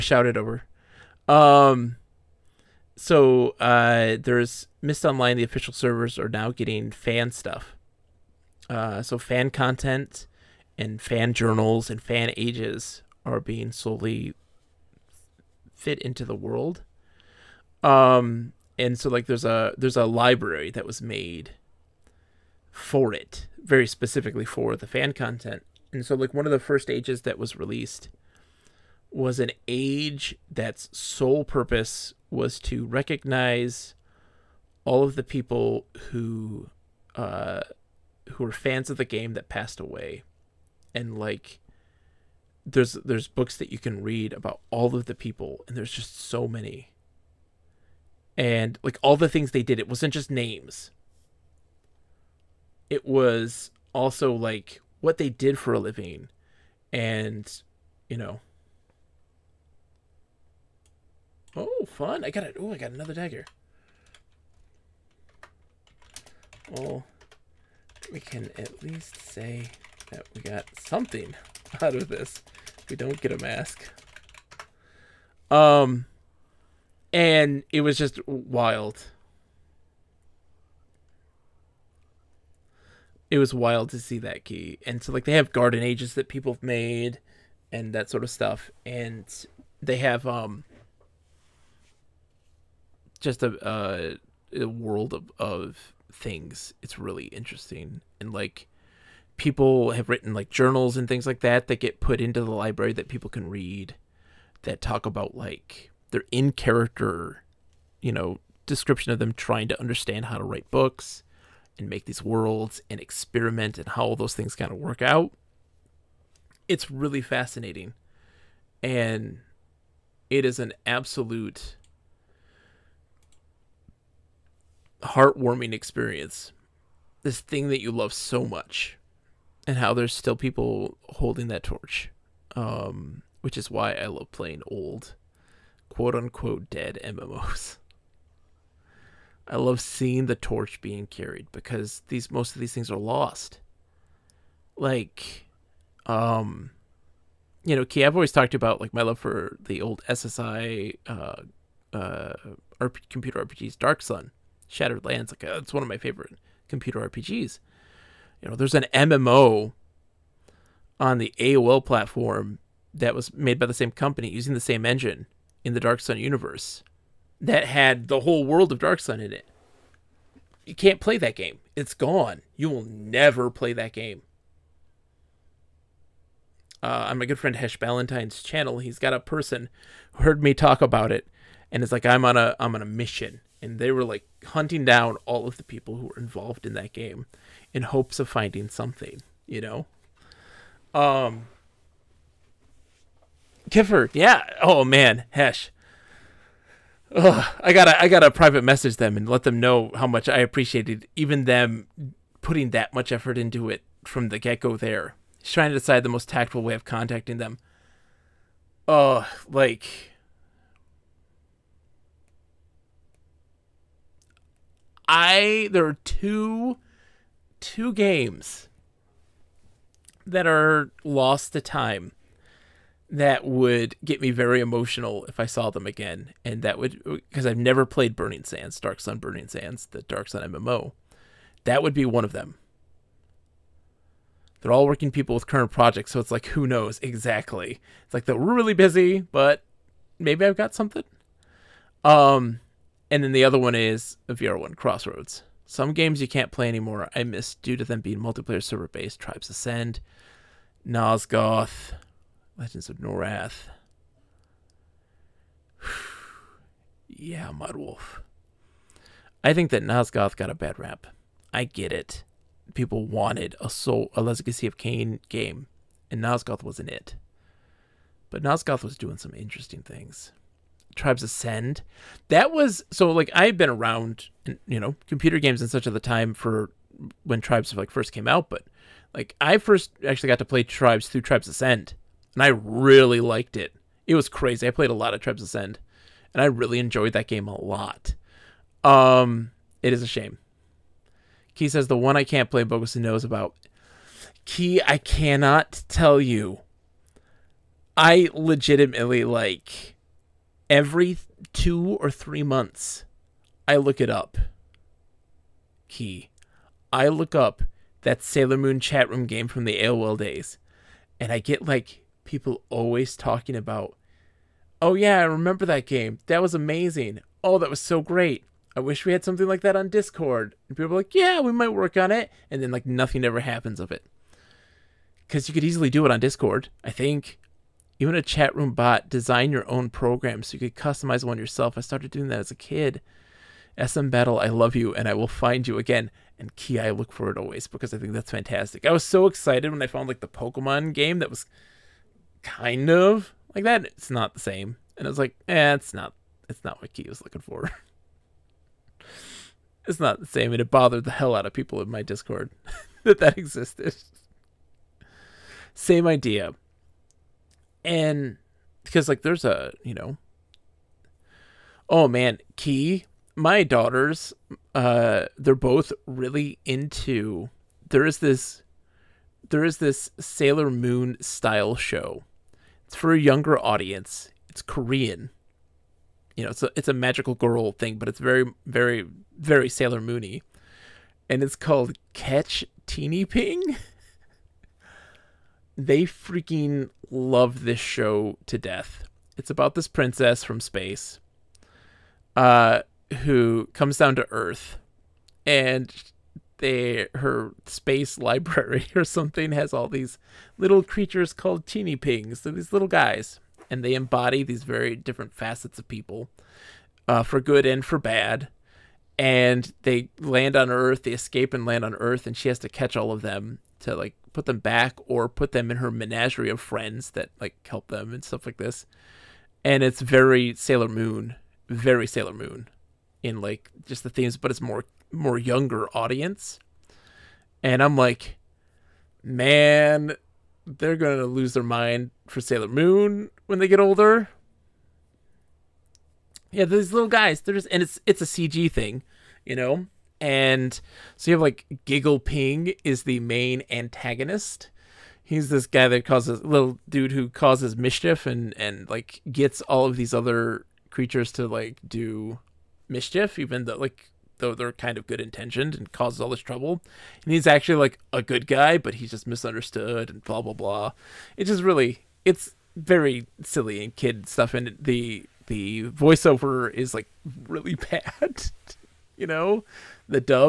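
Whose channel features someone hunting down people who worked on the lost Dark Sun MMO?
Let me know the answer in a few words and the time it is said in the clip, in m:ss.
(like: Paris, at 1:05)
Hesh Ballantyne, at 2:57.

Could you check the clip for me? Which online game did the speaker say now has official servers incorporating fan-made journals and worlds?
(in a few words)
Myst Online.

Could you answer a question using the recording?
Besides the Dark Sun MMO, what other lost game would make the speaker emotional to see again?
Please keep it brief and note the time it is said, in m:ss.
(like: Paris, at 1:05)
VR1 Crossroads, at 4:04.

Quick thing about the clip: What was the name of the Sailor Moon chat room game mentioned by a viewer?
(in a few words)
SM Battle.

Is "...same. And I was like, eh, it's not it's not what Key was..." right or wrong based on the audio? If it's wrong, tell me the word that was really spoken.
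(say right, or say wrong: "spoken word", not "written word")
right.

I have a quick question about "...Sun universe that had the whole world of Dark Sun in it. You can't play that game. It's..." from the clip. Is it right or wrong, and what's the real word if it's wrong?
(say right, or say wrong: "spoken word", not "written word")
right.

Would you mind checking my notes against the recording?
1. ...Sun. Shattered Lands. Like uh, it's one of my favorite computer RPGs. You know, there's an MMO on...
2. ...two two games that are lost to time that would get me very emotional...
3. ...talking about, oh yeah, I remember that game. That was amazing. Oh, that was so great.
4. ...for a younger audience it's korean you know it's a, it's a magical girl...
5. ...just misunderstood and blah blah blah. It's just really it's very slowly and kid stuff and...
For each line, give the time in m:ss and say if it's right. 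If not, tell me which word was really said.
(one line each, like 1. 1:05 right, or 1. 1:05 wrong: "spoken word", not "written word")
1. 2:34 right
2. 3:36 right
3. 5:13 right
4. 6:12 right
5. 7:39 wrong: "silly", not "slowly".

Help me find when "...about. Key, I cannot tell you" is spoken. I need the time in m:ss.
4:53.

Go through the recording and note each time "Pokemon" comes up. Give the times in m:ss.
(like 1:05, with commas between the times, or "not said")
5:40.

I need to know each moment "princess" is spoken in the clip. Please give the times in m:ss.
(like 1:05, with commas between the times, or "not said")
6:29.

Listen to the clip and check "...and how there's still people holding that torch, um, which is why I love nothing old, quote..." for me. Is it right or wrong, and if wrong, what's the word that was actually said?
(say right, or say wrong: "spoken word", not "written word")
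wrong: "playing", not "nothing".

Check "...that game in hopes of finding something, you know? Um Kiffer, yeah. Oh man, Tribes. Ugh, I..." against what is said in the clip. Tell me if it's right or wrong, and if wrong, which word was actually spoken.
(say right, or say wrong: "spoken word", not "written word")
wrong: "Hesh", not "Tribes".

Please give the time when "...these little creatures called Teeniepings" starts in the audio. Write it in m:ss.
6:39.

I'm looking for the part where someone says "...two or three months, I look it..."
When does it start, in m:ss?
5:01.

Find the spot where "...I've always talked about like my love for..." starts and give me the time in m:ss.
2:28.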